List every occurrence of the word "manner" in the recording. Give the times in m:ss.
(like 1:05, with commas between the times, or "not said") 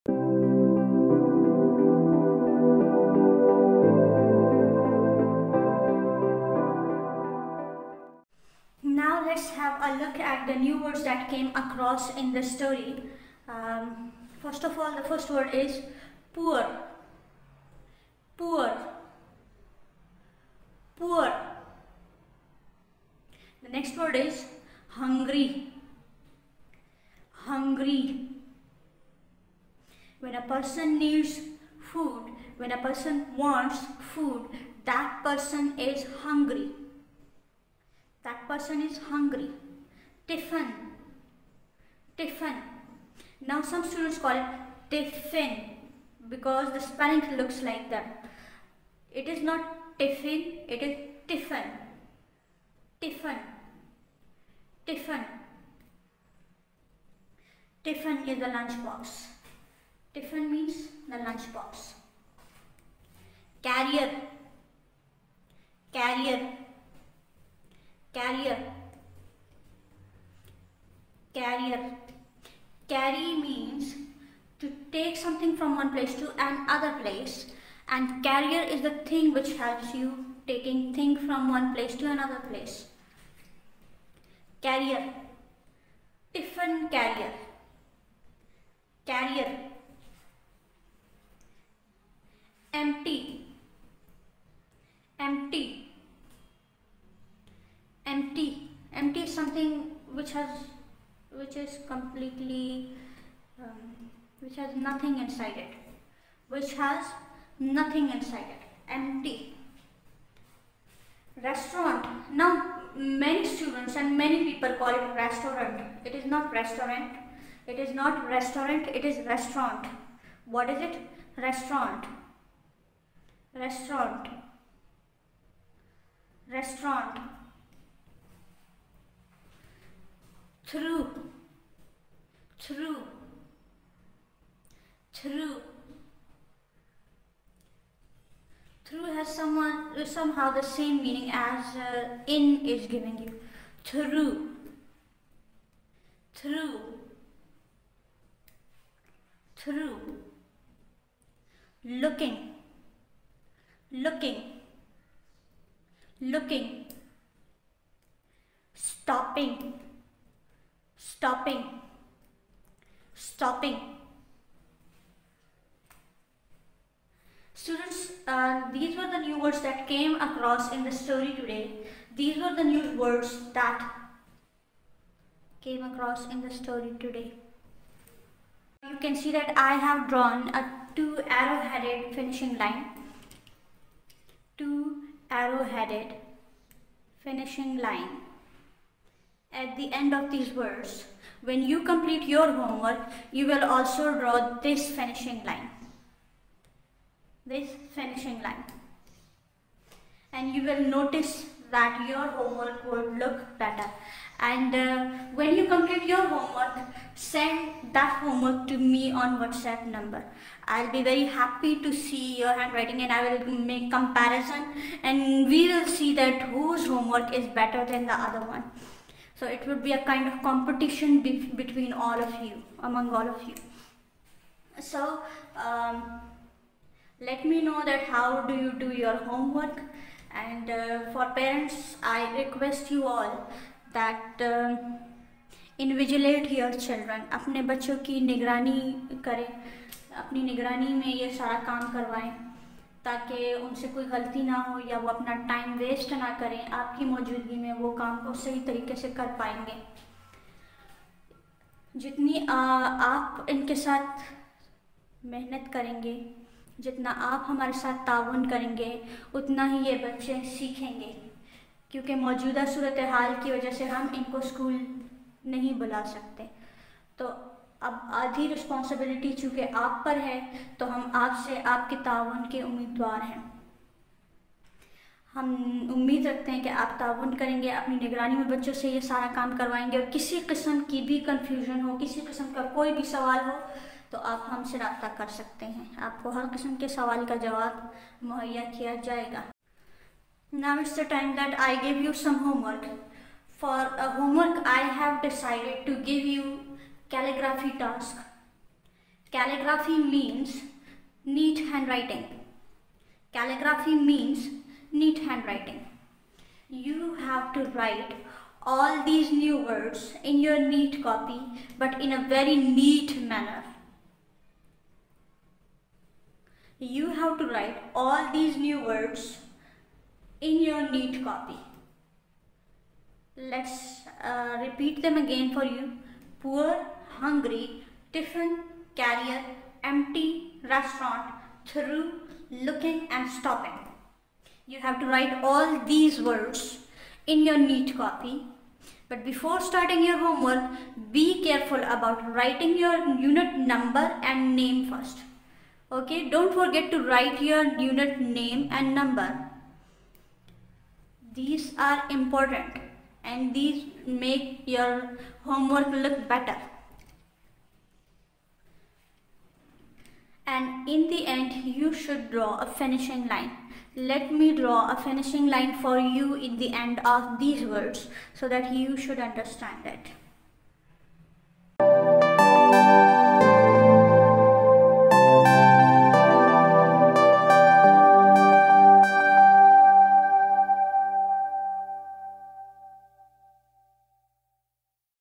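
5:13.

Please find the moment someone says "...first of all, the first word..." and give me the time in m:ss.
0:14.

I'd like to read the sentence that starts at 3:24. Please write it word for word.
And uh, when you complete your homework, send that homework to me on WhatsApp number.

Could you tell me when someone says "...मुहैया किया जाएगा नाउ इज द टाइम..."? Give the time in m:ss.
4:48.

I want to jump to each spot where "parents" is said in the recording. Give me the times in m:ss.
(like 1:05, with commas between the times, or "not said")
3:51.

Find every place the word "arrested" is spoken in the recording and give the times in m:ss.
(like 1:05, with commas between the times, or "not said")
not said.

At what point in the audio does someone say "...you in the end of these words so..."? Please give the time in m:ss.
6:05.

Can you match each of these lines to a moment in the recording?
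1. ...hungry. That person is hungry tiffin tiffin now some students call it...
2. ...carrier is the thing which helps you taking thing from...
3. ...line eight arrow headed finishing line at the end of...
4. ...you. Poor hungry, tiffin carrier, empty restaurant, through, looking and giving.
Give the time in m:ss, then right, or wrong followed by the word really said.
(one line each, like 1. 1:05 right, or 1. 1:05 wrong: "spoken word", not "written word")
1. 0:36 right
2. 1:18 right
3. 3:02 wrong: "two", not "eight"
4. 5:25 wrong: "stopping", not "giving".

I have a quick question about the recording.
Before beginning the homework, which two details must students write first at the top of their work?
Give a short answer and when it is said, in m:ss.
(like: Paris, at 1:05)
Unit number and name, at 5:43.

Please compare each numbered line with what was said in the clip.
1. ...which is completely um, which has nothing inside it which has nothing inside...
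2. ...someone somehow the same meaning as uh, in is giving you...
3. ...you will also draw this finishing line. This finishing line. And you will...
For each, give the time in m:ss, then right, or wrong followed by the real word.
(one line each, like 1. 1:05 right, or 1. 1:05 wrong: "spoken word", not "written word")
1. 1:41 right
2. 2:19 right
3. 3:13 right.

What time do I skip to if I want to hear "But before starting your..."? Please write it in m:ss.
5:39.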